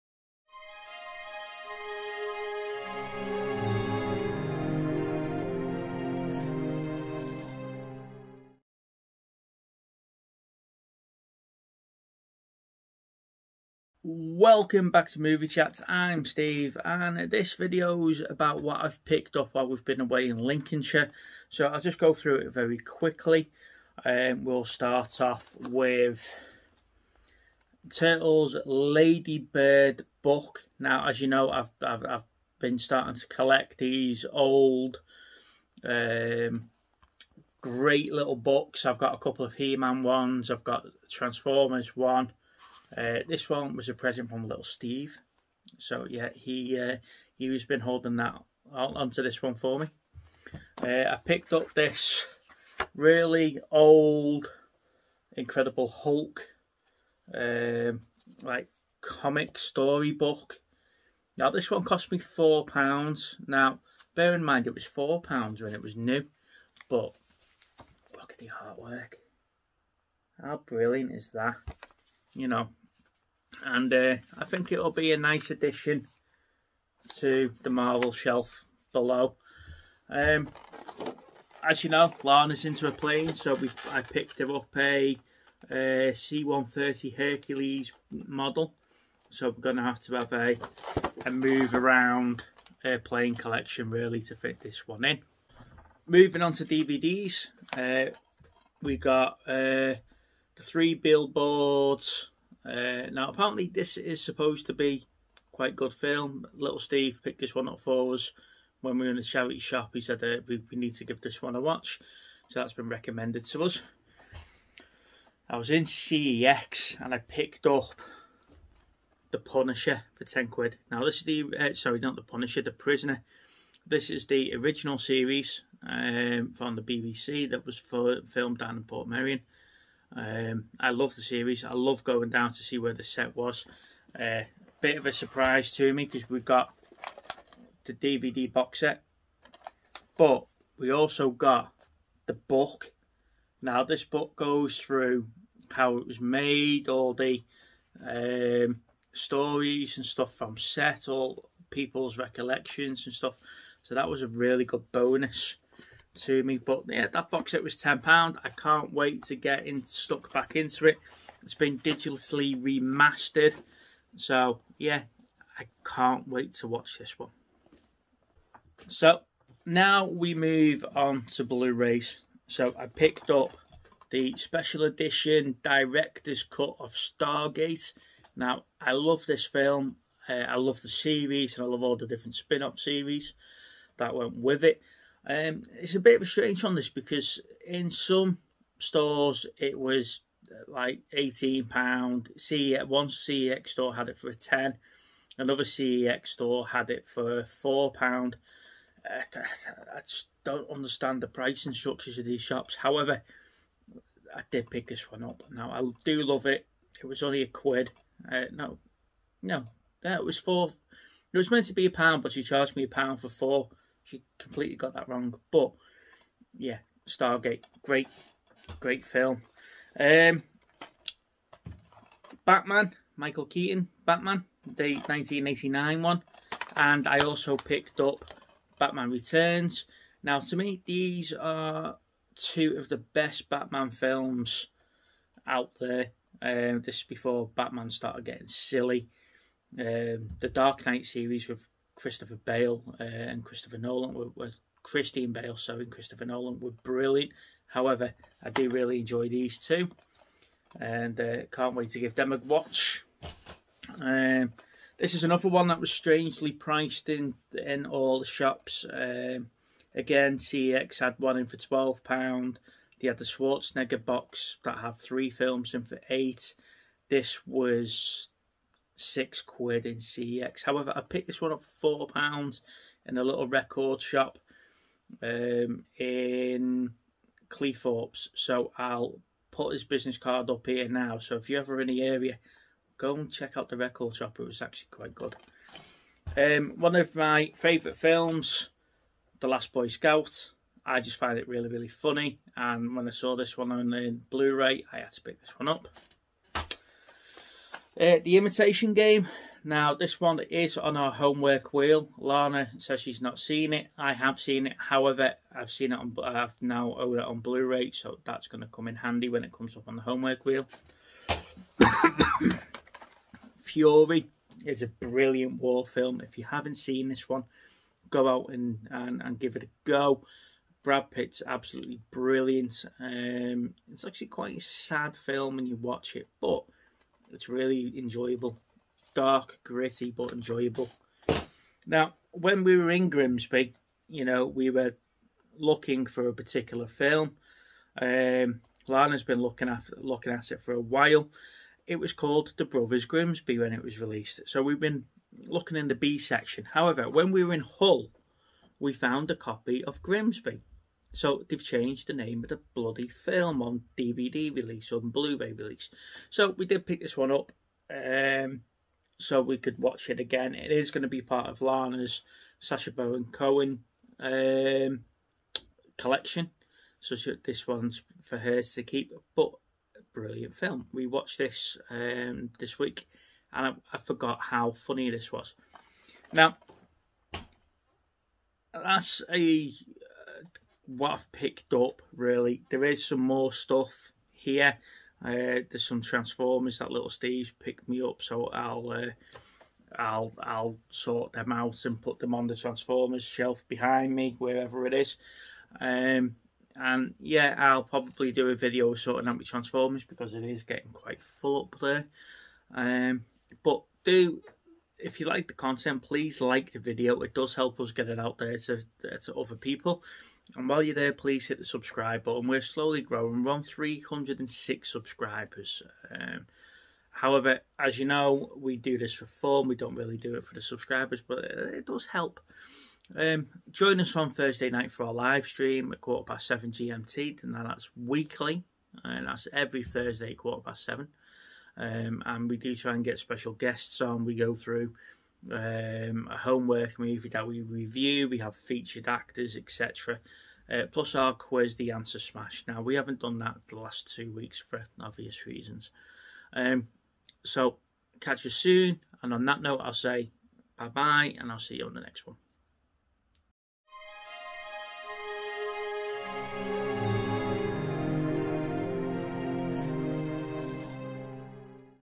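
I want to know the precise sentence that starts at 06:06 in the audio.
So she, this one's for her to keep.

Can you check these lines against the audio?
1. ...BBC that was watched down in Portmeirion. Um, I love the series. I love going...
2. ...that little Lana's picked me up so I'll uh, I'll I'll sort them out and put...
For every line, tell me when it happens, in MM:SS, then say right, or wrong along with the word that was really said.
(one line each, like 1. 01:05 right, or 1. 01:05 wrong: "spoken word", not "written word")
1. 02:06 wrong: "filmed", not "watched"
2. 06:26 wrong: "Steve", not "Lana".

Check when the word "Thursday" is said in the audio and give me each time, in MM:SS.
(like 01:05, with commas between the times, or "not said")
07:04, 07:09.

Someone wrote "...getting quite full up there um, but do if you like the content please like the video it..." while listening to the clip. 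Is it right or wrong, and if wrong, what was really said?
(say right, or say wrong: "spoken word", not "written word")
right.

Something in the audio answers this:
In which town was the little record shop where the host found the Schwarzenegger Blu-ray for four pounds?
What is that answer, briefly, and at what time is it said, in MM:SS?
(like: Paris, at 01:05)
Cleethorpes, at 04:37.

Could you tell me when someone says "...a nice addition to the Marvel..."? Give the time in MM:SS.
01:15.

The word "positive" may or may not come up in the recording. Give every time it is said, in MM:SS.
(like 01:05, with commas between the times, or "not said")
not said.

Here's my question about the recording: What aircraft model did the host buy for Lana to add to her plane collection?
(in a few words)
130 Hercules.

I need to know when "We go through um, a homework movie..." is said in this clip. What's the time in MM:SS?
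07:14.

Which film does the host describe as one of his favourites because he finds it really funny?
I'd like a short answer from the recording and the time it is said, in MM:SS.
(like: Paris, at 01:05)
The Last Boy Scout, at 04:49.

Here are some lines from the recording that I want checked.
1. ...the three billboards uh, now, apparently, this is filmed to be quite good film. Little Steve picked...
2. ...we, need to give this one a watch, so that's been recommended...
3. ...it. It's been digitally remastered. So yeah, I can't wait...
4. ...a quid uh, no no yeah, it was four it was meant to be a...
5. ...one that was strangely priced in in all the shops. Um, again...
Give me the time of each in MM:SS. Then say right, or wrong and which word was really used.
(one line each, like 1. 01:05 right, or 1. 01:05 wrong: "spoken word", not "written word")
1. 01:40 wrong: "supposed", not "filmed"
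2. 01:50 right
3. 02:40 right
4. 03:27 right
5. 04:15 right.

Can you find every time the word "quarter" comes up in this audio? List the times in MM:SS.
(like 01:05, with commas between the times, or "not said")
07:06, 07:10.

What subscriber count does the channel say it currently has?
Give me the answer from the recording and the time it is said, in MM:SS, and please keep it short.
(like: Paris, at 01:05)
306, at 06:53.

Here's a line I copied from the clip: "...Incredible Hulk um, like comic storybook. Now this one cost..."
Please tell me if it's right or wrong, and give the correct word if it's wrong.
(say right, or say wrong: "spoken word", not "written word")
right.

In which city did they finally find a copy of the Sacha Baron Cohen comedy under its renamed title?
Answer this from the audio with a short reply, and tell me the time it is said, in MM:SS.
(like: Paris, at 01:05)
Hull, at 05:47.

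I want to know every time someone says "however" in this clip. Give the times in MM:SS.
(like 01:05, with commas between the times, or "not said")
03:22, 04:07, 04:30, 05:04, 05:46, 06:57.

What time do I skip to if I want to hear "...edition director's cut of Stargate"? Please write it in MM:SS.
02:54.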